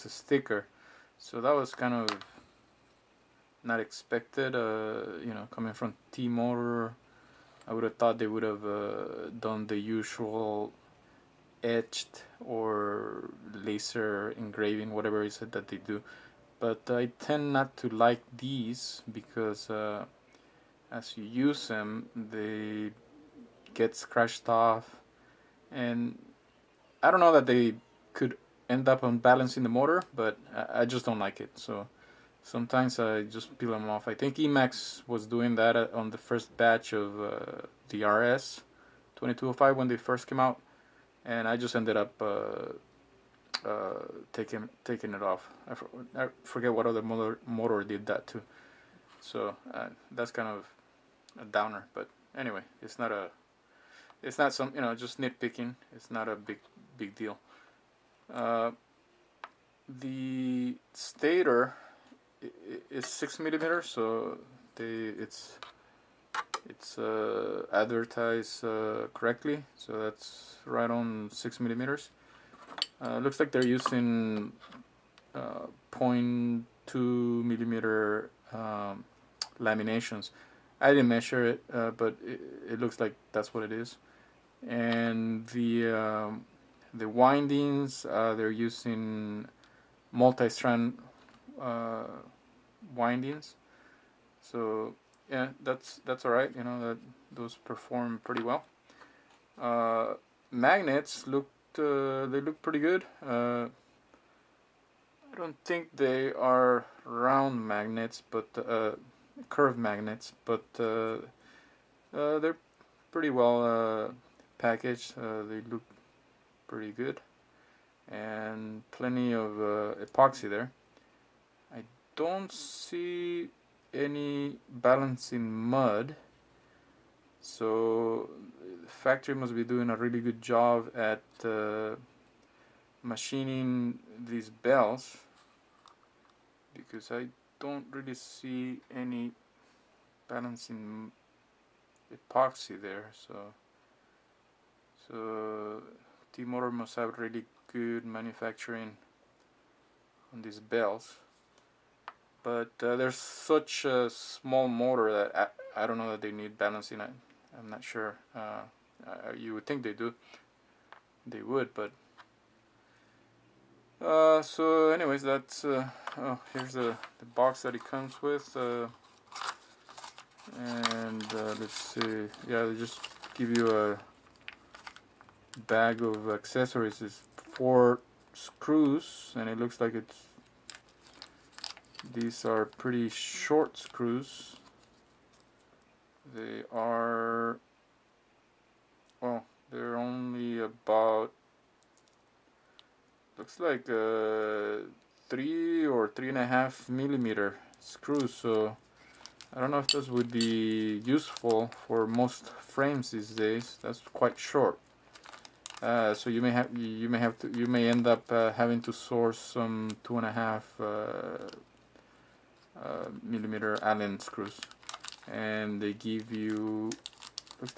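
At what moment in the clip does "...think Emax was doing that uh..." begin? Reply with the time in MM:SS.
00:34.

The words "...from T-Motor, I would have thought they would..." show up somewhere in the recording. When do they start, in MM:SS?
00:05.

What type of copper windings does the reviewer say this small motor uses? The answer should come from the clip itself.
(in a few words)
Multi-strand.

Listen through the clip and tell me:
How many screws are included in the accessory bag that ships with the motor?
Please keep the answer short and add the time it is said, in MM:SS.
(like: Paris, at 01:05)
4, at 02:57.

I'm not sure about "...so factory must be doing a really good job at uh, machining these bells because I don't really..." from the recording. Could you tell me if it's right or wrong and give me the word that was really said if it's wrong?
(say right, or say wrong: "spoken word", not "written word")
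right.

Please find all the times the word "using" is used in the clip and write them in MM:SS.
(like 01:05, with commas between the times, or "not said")
01:13, 01:28.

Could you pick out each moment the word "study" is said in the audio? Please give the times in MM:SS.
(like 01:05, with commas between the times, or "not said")
not said.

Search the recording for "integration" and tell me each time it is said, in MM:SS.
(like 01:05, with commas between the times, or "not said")
not said.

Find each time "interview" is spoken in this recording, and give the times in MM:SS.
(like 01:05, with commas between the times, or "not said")
not said.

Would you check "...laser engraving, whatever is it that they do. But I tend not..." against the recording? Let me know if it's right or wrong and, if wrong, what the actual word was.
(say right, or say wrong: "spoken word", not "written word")
right.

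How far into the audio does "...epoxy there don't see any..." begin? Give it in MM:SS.
02:00.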